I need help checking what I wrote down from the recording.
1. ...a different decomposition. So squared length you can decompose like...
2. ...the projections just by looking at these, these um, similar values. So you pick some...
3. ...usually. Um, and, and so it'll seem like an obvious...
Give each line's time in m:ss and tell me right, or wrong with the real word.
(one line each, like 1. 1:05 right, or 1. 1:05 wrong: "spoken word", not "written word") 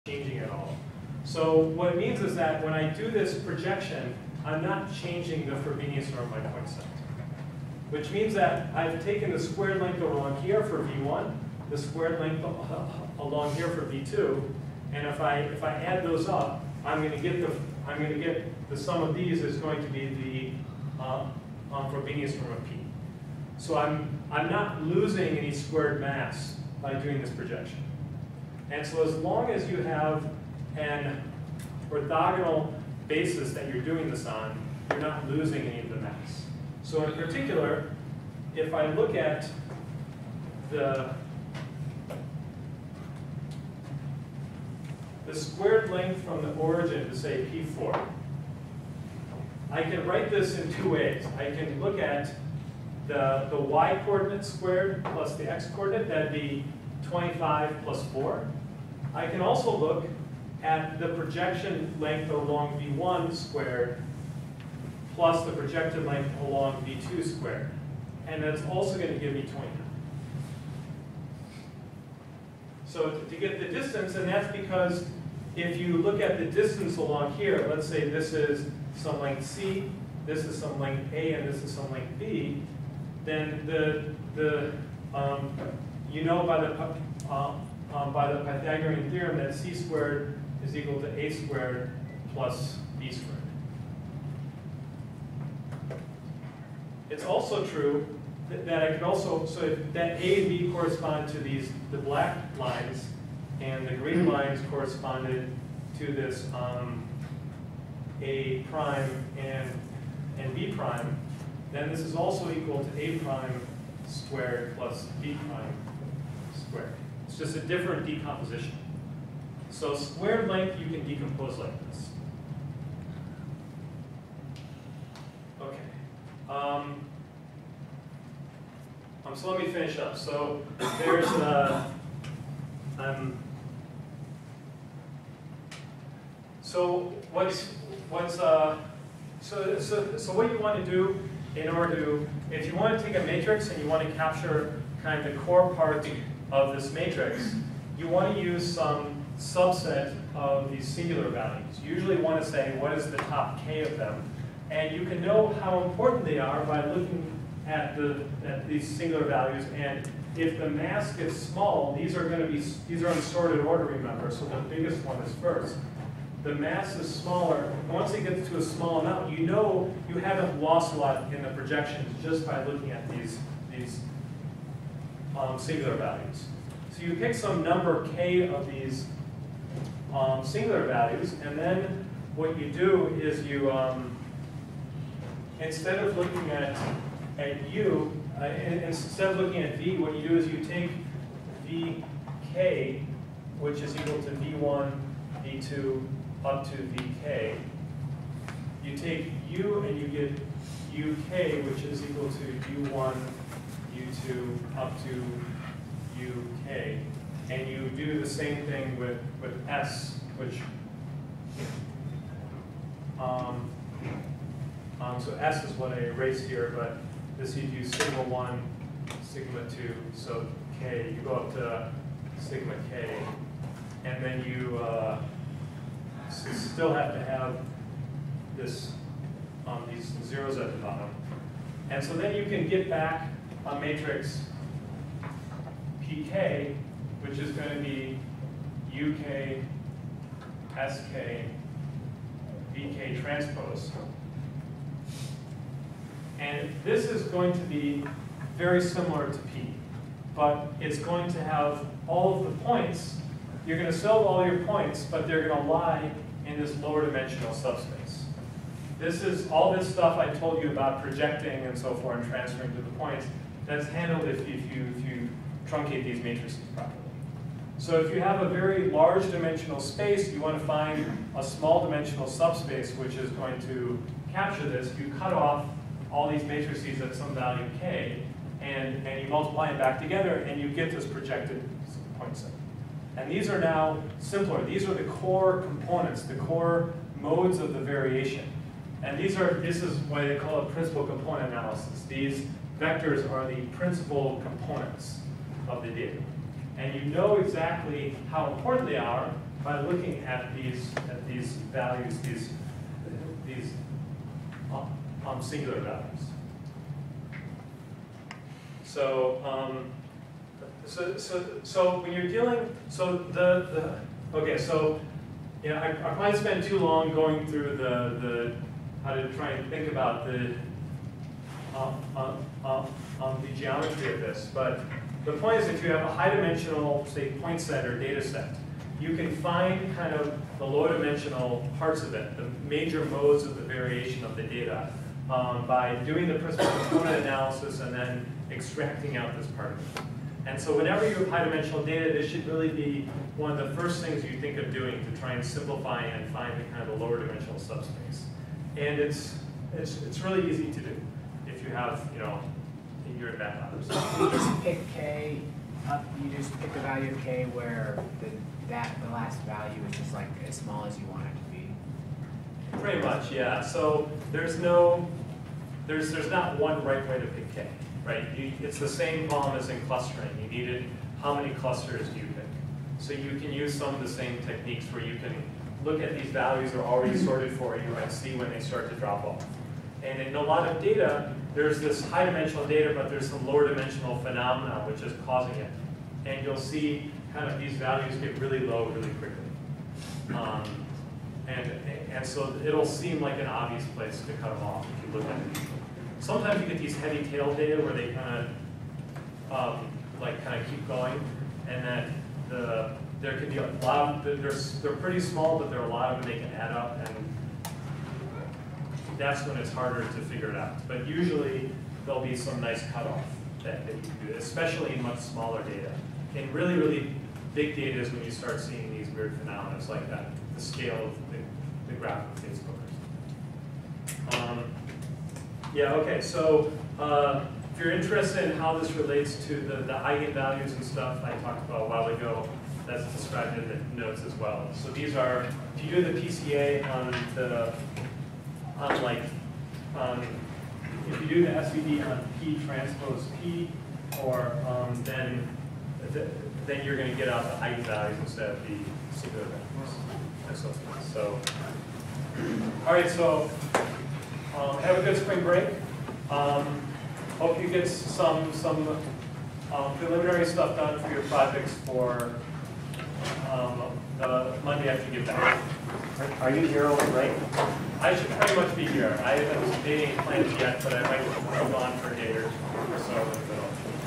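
1. 1:57 right
2. 2:51 wrong: "singular", not "similar"
3. 6:29 wrong: "quickly", not "usually".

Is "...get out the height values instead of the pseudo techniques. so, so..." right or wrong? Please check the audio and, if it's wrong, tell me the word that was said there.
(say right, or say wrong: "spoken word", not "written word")
wrong: "values", not "techniques".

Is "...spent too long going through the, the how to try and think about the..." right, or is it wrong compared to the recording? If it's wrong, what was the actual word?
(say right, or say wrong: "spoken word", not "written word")
right.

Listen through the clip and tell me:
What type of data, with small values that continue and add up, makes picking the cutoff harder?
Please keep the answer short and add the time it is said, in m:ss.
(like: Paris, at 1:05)
heavy tail data, at 6:36.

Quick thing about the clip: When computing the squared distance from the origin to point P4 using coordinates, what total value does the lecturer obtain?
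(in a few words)
29.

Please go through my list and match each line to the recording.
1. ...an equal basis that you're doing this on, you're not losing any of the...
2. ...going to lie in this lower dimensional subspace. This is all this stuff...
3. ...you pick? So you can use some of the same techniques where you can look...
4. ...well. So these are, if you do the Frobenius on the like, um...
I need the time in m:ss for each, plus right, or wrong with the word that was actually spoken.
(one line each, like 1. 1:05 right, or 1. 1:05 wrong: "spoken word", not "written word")
1. 0:30 wrong: "orthogonal", not "equal"
2. 4:15 right
3. 6:12 right
4. 7:14 wrong: "PCA", not "Frobenius".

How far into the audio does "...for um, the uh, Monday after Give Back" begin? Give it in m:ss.
7:41.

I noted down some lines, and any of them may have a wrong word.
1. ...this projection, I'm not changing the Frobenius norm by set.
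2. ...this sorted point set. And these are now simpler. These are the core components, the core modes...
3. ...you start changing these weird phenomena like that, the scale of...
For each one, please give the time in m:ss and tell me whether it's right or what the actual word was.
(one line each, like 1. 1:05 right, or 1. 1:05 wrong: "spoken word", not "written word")
1. 0:03 right
2. 4:40 wrong: "projected", not "sorted"
3. 6:58 wrong: "seeing", not "changing".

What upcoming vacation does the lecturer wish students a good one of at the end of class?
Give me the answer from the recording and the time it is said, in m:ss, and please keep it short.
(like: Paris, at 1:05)
spring break, at 7:35.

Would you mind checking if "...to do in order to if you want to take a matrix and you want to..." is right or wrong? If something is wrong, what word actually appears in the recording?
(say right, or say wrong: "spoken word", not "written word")
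right.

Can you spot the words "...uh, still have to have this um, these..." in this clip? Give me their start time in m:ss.
3:44.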